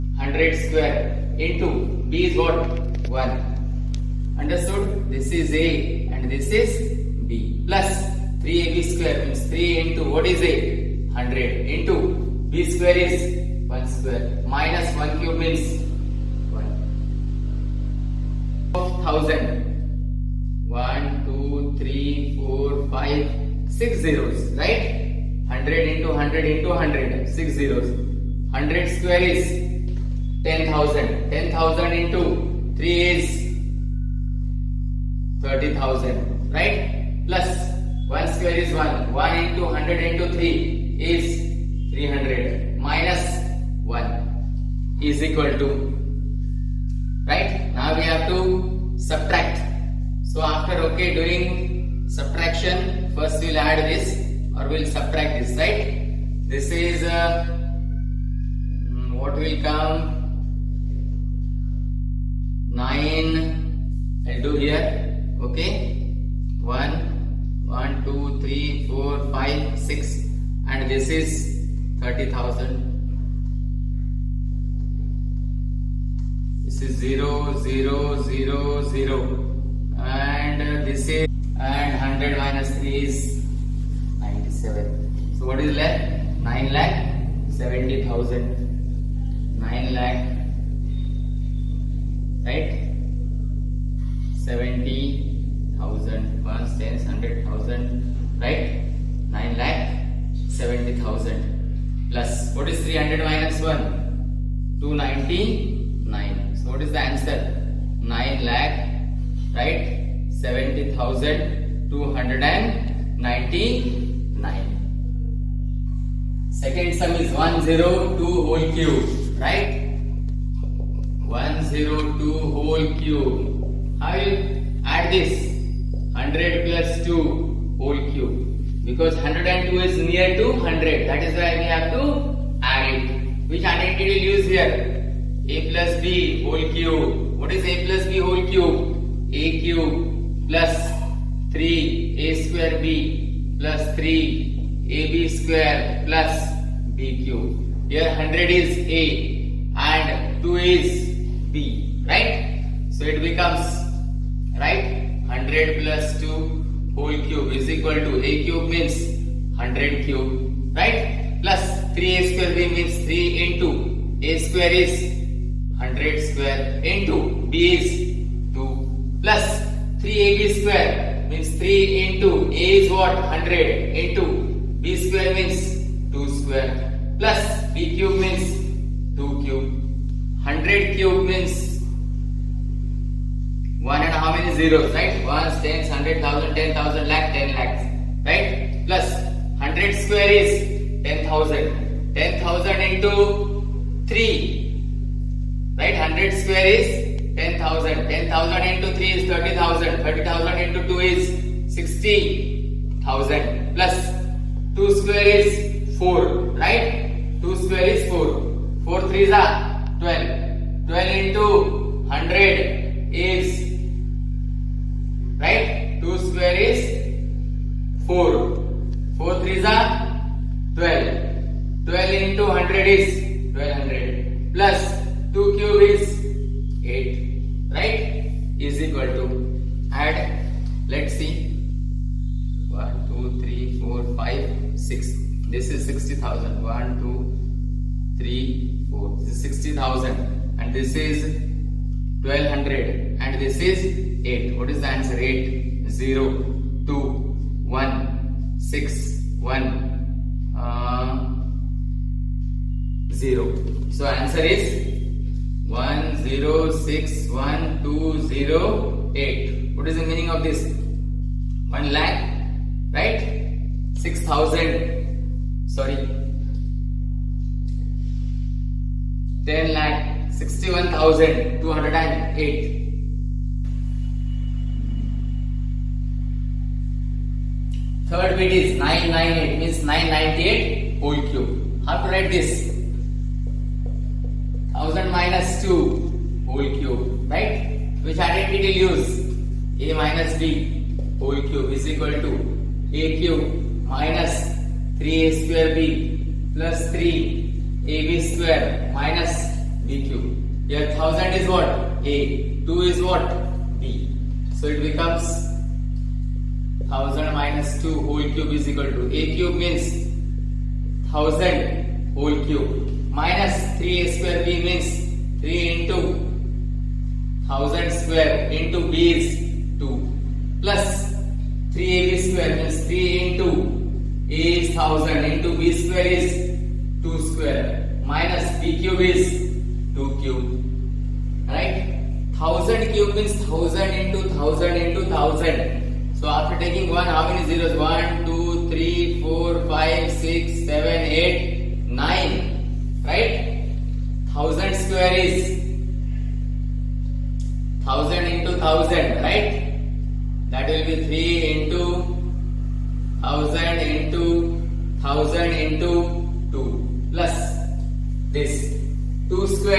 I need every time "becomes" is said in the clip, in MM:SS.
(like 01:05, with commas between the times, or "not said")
02:33, 05:04.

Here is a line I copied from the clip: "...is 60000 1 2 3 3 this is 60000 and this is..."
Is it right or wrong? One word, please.
wrong.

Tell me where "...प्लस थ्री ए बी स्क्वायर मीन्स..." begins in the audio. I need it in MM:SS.
00:07.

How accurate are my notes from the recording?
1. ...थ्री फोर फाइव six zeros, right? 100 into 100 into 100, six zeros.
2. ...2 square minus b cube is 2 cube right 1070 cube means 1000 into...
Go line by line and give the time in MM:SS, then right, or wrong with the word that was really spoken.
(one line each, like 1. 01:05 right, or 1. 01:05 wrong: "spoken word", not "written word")
1. 00:21 right
2. 05:27 wrong: "1000", not "1070".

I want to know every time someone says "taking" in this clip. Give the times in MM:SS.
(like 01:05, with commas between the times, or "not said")
05:36.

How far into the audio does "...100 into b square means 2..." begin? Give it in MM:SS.
02:53.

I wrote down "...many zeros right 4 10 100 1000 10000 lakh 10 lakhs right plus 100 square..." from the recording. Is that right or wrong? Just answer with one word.
wrong.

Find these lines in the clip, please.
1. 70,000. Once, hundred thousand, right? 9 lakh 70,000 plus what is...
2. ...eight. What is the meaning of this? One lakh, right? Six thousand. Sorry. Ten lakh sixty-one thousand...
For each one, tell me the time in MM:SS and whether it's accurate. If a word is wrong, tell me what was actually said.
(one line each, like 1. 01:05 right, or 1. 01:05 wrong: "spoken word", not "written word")
1. 01:34 right
2. 04:19 right.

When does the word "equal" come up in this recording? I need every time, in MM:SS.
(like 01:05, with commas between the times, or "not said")
00:45, 02:37, 03:48, 04:51, 05:08.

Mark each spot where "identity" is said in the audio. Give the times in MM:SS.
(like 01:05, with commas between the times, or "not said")
02:13, 04:48.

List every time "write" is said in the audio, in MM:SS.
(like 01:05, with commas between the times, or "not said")
04:42.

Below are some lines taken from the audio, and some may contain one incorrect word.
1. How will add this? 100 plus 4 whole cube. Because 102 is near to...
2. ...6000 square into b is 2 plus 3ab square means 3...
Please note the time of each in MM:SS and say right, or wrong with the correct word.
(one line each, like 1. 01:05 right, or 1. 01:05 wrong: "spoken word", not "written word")
1. 02:03 wrong: "2", not "4"
2. 05:17 wrong: "1000", not "6000".